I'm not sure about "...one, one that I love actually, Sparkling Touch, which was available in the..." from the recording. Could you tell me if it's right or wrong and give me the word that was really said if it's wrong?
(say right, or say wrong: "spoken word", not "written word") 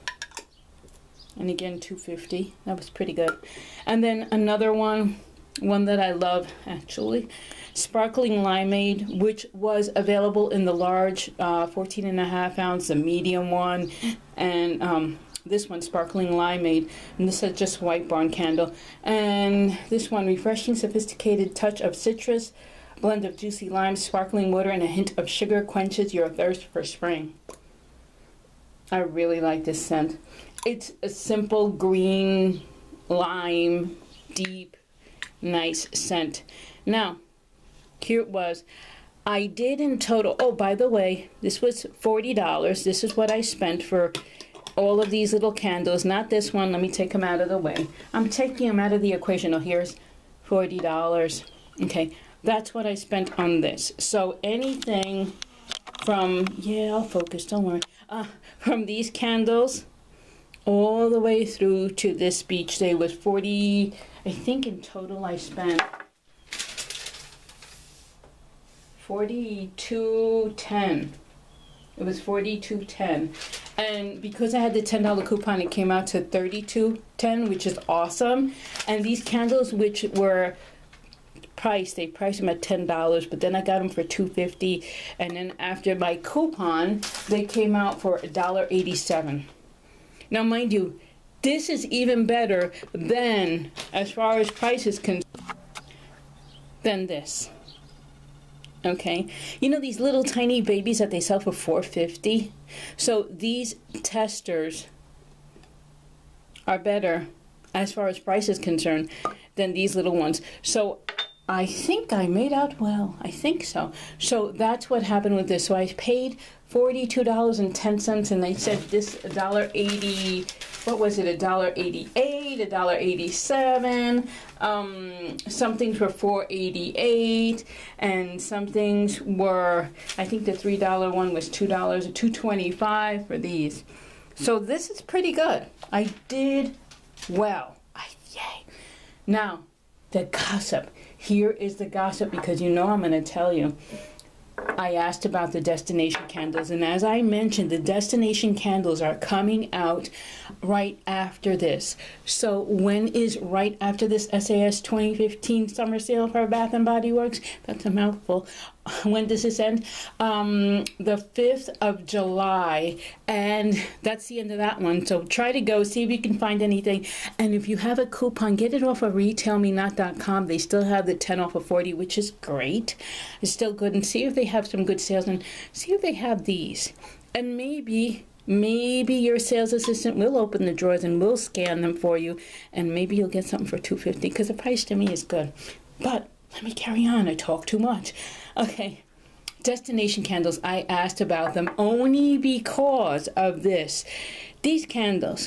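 wrong: "Limeade", not "Touch".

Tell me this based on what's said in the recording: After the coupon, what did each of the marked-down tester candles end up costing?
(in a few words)
$1.87.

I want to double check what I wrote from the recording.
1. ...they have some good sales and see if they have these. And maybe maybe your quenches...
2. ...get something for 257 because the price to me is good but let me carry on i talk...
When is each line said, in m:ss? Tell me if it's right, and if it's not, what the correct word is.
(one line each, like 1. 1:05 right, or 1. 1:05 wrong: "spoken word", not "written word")
1. 2:54 wrong: "sales", not "quenches"
2. 3:03 wrong: "250", not "257".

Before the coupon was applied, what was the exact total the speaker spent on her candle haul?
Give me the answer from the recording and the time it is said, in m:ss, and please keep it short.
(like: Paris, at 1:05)
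$42.10, at 1:09.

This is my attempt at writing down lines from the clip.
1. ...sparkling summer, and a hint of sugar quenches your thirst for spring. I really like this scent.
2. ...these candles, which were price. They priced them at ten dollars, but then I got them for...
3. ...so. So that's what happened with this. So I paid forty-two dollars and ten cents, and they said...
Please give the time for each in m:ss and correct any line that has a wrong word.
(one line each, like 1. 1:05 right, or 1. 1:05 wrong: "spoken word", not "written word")
1. 0:23 wrong: "water", not "summer"
2. 1:19 right
3. 1:53 right.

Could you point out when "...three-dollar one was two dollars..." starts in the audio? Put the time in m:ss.
2:10.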